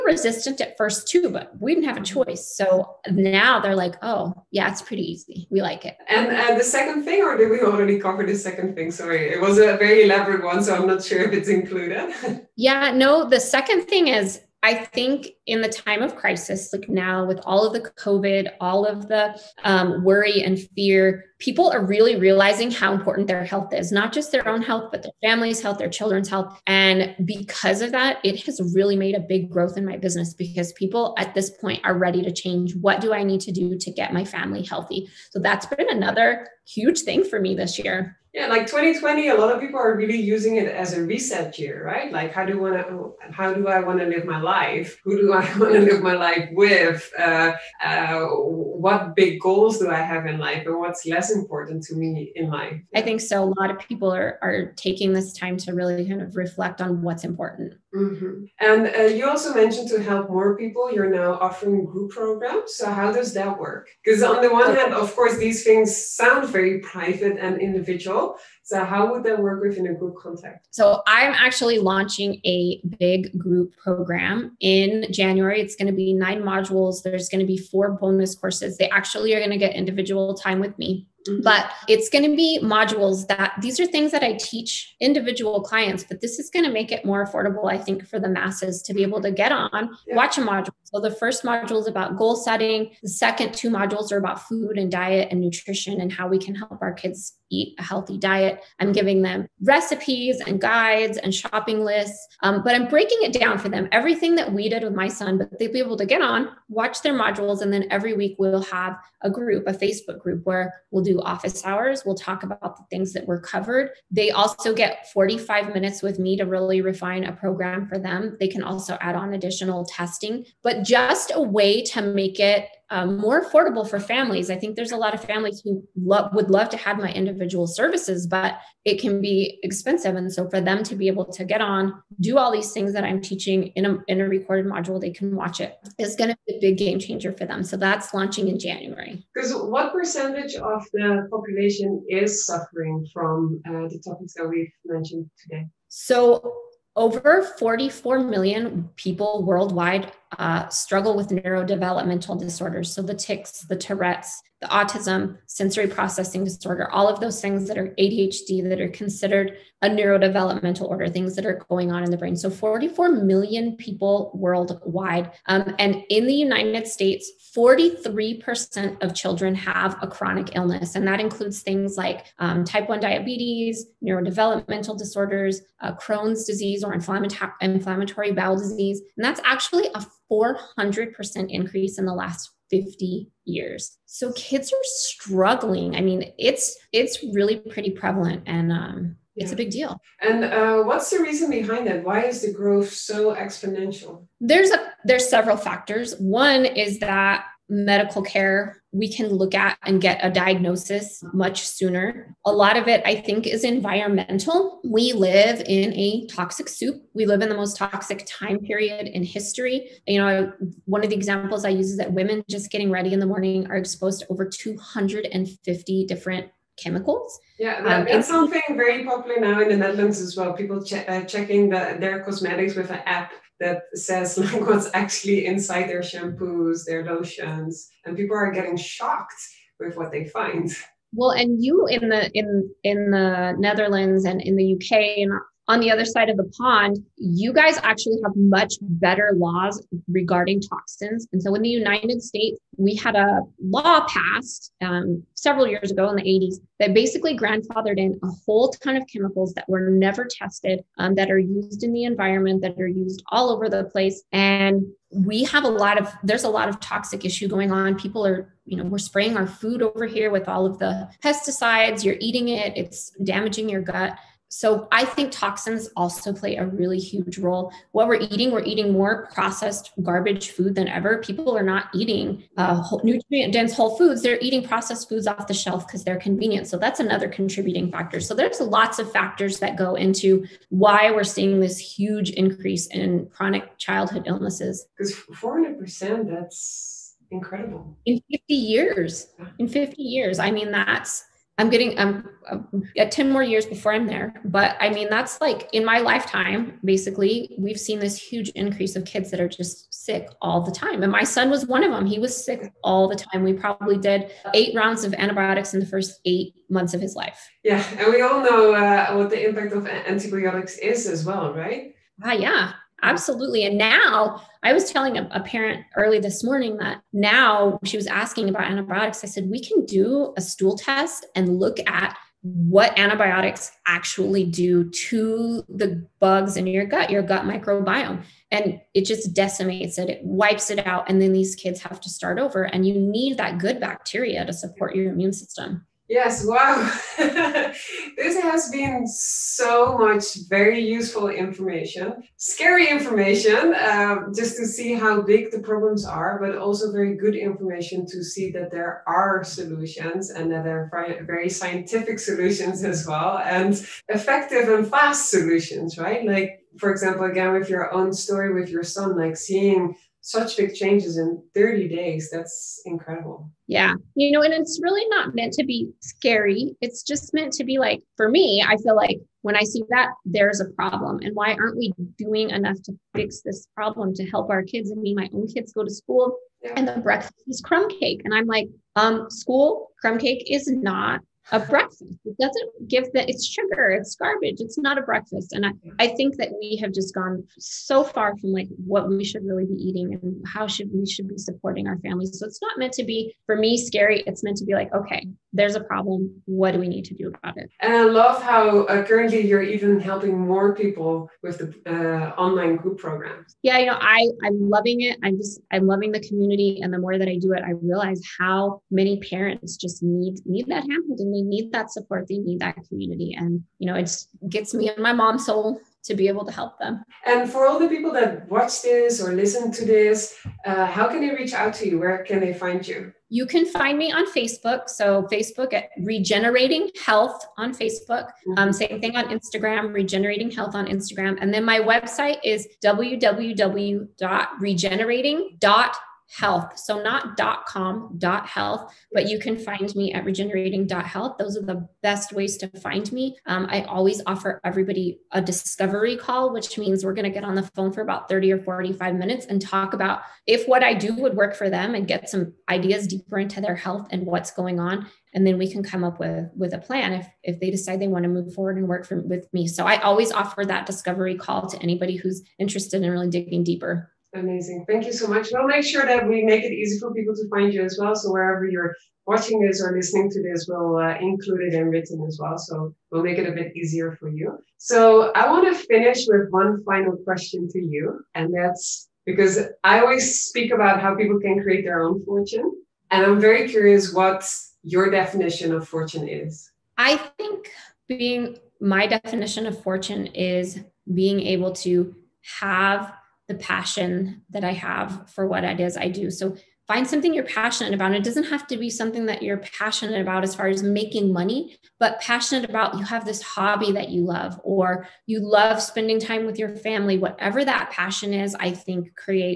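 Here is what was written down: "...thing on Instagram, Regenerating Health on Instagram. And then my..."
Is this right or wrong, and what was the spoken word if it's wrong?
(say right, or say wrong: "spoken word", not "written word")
right.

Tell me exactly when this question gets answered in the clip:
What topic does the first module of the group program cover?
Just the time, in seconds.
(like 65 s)
92 s.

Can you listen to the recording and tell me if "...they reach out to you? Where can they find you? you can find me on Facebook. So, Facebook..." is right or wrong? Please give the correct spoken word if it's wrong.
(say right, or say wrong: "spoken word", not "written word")
right.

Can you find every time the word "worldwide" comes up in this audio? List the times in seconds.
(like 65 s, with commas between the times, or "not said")
149 s, 164 s.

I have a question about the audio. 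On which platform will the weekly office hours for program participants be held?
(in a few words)
Facebook group.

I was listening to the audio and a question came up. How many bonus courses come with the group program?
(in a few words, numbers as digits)
4.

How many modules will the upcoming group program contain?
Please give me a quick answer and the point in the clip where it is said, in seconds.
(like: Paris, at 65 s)
9, at 76 s.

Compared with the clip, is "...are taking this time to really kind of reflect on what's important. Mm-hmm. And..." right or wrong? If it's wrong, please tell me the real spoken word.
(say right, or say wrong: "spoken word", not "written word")
right.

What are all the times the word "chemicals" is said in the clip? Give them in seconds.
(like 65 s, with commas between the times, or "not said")
216 s, 249 s.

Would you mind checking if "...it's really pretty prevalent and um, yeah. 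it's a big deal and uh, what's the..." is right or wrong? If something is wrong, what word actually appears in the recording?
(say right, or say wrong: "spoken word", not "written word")
right.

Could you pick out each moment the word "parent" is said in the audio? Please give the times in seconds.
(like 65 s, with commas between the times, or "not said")
315 s, 409 s.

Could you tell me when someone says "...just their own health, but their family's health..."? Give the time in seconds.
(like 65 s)
24 s.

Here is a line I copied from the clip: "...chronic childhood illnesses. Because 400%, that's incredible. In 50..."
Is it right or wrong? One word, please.
right.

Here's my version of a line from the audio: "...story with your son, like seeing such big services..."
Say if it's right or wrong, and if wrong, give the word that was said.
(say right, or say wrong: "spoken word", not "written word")
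wrong: "changes", not "services".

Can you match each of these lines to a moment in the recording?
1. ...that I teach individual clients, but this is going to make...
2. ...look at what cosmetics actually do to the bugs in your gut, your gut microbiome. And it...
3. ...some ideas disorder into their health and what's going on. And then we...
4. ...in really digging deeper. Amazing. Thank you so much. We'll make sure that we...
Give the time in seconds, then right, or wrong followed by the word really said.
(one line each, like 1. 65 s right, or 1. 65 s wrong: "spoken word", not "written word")
1. 84 s right
2. 321 s wrong: "antibiotics", not "cosmetics"
3. 452 s wrong: "deeper", not "disorder"
4. 463 s right.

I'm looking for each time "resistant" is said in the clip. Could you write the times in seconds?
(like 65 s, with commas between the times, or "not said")
0 s.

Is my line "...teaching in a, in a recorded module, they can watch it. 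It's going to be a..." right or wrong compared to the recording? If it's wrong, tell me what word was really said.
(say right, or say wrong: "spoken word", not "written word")
right.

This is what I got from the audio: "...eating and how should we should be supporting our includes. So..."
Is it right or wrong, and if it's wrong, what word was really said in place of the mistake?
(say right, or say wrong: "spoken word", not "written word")
wrong: "families", not "includes".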